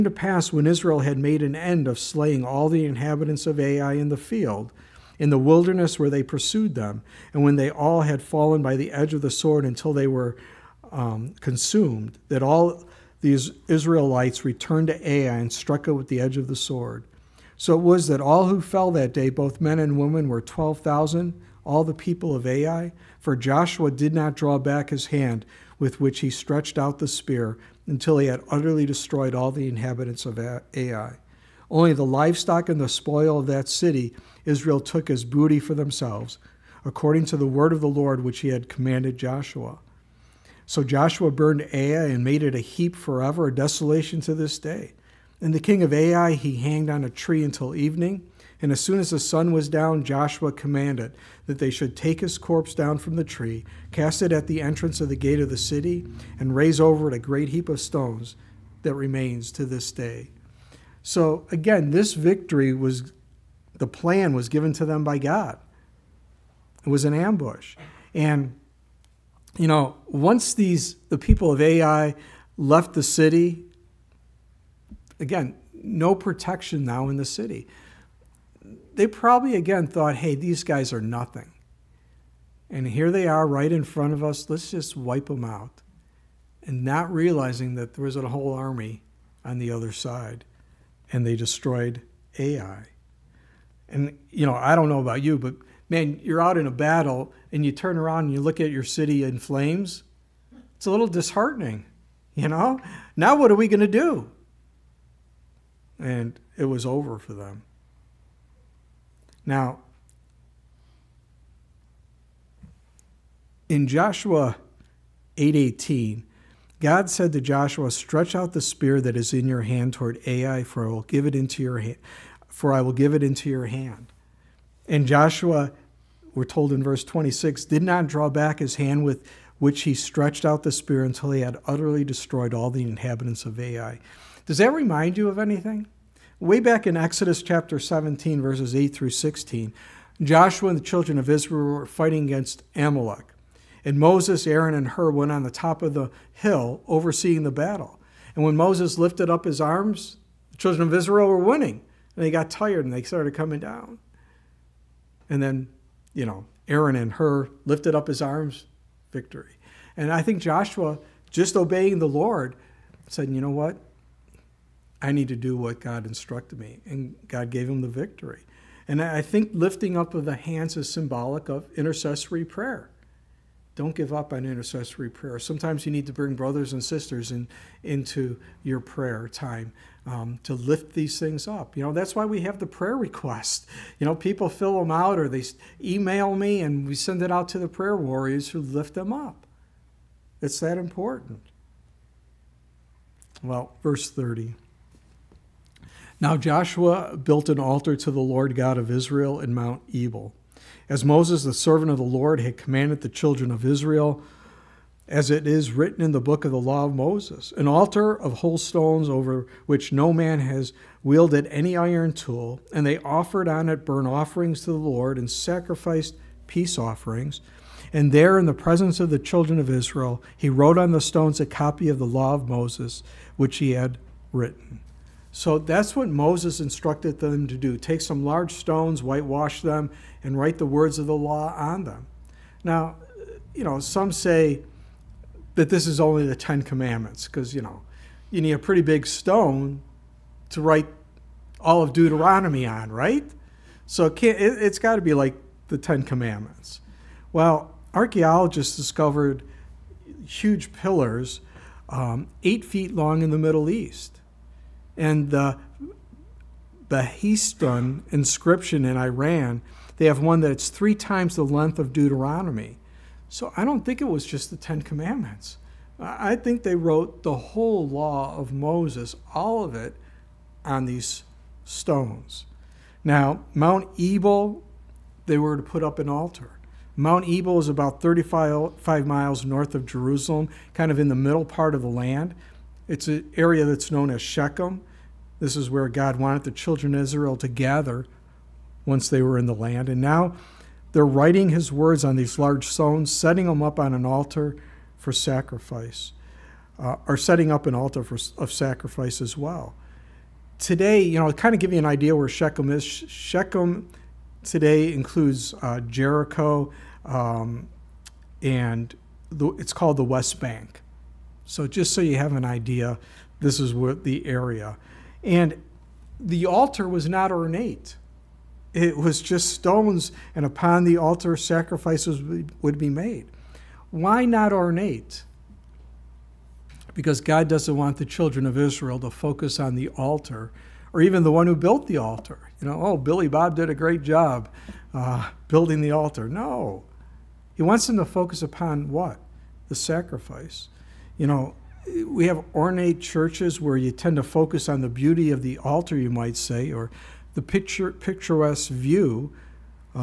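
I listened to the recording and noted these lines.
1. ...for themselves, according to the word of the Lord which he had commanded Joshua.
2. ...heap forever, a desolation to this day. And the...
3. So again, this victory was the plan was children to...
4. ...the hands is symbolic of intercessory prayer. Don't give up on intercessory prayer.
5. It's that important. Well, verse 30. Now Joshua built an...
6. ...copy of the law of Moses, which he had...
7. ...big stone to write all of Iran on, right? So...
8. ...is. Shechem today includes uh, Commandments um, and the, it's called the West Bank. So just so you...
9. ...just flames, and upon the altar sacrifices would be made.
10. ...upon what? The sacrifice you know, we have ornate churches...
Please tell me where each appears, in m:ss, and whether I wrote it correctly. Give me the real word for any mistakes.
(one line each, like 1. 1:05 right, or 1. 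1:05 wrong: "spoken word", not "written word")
1. 0:35 right
2. 0:42 right
3. 1:01 wrong: "given", not "children"
4. 2:50 right
5. 3:10 right
6. 3:41 right
7. 3:58 wrong: "Deuteronomy", not "Iran"
8. 5:02 wrong: "Jericho", not "Commandments"
9. 5:19 wrong: "stones", not "flames"
10. 5:38 right.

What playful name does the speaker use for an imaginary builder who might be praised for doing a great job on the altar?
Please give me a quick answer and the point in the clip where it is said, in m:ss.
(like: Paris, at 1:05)
Billy Bob, at 5:32.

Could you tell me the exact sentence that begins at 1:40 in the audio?
It's a little disheartening, you know?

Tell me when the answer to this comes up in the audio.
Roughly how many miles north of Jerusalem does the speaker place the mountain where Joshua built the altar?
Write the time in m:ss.
4:38.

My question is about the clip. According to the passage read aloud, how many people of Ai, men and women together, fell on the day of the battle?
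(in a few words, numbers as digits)
12,000.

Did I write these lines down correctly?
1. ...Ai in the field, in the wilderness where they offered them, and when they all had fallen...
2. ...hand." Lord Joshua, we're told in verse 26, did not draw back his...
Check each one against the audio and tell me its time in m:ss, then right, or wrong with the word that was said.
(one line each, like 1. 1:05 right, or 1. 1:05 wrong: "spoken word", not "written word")
1. 0:03 wrong: "pursued", not "offered"
2. 2:03 wrong: "And", not "Lord".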